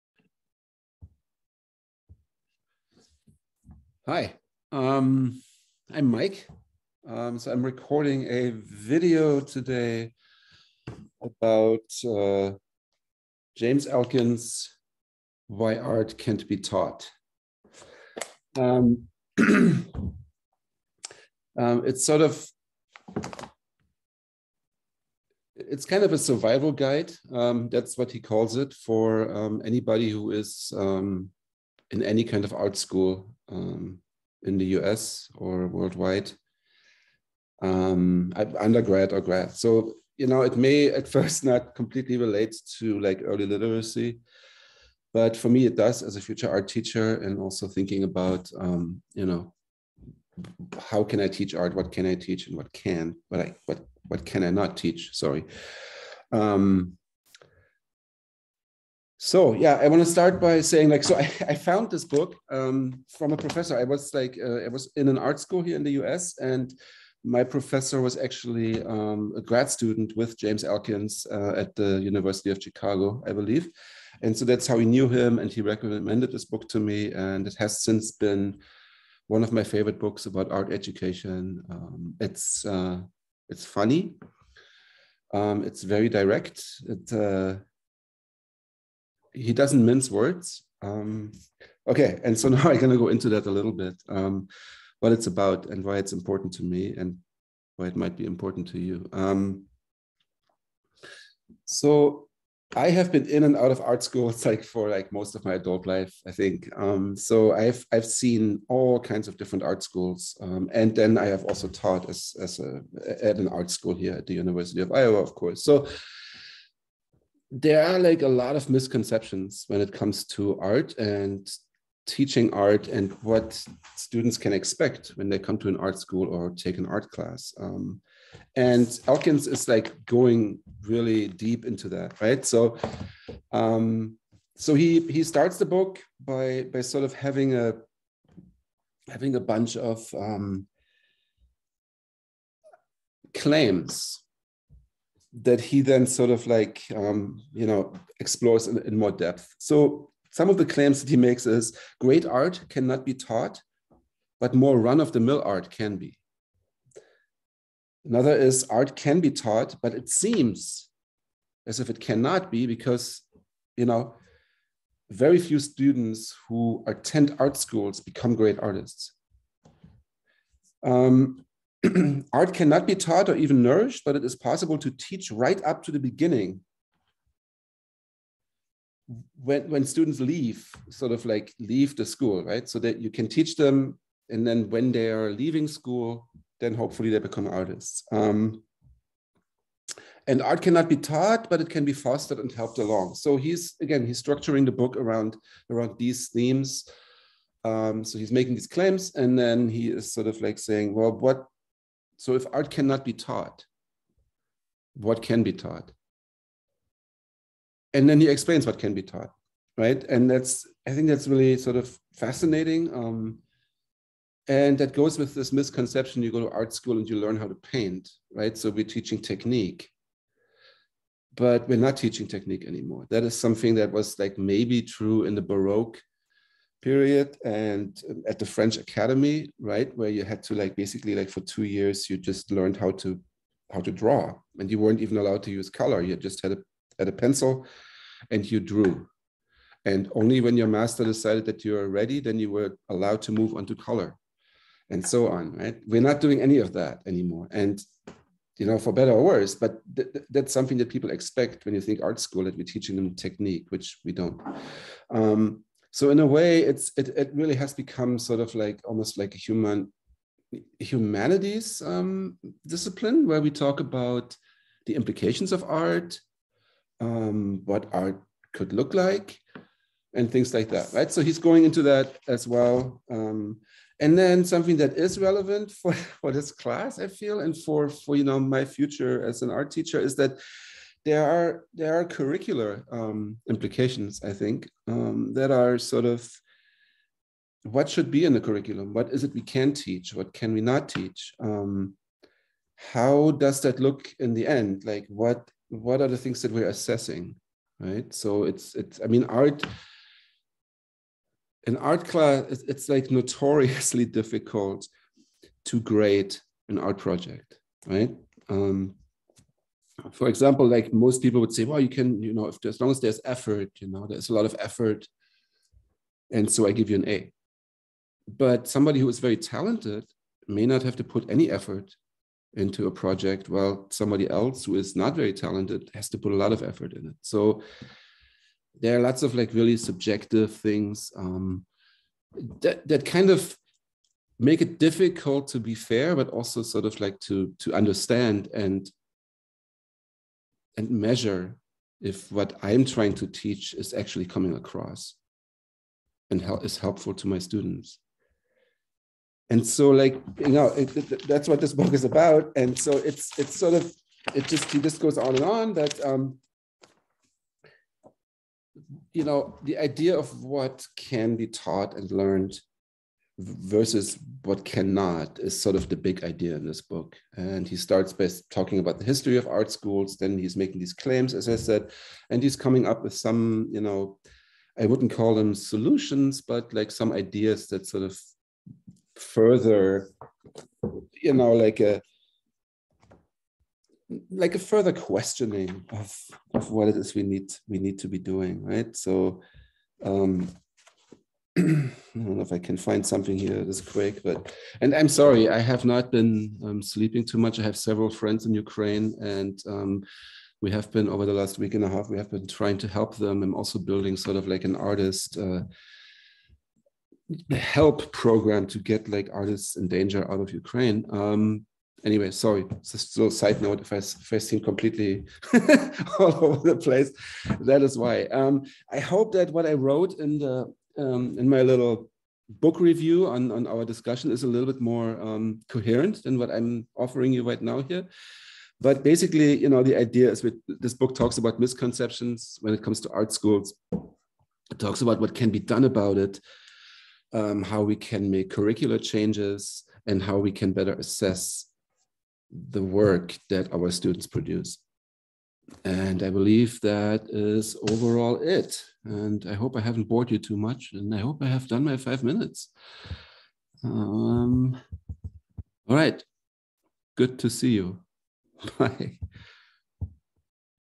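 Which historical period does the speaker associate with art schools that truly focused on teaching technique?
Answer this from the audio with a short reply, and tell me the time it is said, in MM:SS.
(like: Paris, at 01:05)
Baroque period, at 03:45.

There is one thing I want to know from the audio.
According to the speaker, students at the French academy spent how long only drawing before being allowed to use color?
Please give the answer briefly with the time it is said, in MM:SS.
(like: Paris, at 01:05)
2 years, at 03:51.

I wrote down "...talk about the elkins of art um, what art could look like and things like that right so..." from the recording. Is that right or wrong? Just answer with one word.
wrong.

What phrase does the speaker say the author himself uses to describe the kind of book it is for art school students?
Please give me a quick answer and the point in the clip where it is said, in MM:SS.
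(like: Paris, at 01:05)
survival guide, at 00:26.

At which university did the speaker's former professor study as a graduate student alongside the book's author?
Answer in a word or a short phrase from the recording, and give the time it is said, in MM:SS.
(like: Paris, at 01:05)
University of Chicago, at 01:12.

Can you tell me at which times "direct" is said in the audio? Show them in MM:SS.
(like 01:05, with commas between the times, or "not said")
01:26.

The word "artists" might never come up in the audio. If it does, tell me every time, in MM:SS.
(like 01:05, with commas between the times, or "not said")
02:48, 03:07, 06:44, 06:49.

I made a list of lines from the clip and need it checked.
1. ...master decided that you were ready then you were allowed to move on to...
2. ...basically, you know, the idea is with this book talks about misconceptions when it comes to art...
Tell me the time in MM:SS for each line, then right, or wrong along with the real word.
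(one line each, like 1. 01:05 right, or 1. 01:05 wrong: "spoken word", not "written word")
1. 04:00 right
2. 07:09 right.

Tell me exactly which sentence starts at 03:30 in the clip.
And that's, I think that's really sort of fascinating.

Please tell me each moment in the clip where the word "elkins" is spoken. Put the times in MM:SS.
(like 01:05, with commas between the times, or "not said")
00:13, 01:10, 02:09.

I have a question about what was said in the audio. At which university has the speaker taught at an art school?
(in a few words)
University of Iowa.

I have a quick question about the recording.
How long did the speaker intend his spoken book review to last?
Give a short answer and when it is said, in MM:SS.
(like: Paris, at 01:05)
5 minutes, at 07:31.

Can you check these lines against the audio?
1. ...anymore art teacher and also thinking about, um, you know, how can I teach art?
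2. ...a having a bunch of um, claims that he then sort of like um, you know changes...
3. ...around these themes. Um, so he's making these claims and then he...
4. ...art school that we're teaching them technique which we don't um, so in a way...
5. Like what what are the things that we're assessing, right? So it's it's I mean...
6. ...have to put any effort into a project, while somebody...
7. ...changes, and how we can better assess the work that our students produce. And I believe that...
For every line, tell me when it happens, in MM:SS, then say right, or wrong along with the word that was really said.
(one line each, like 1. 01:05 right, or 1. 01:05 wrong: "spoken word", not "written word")
1. 00:46 wrong: "future", not "anymore"
2. 02:17 wrong: "explores", not "changes"
3. 03:15 right
4. 04:12 right
5. 04:54 right
6. 05:20 right
7. 07:19 right.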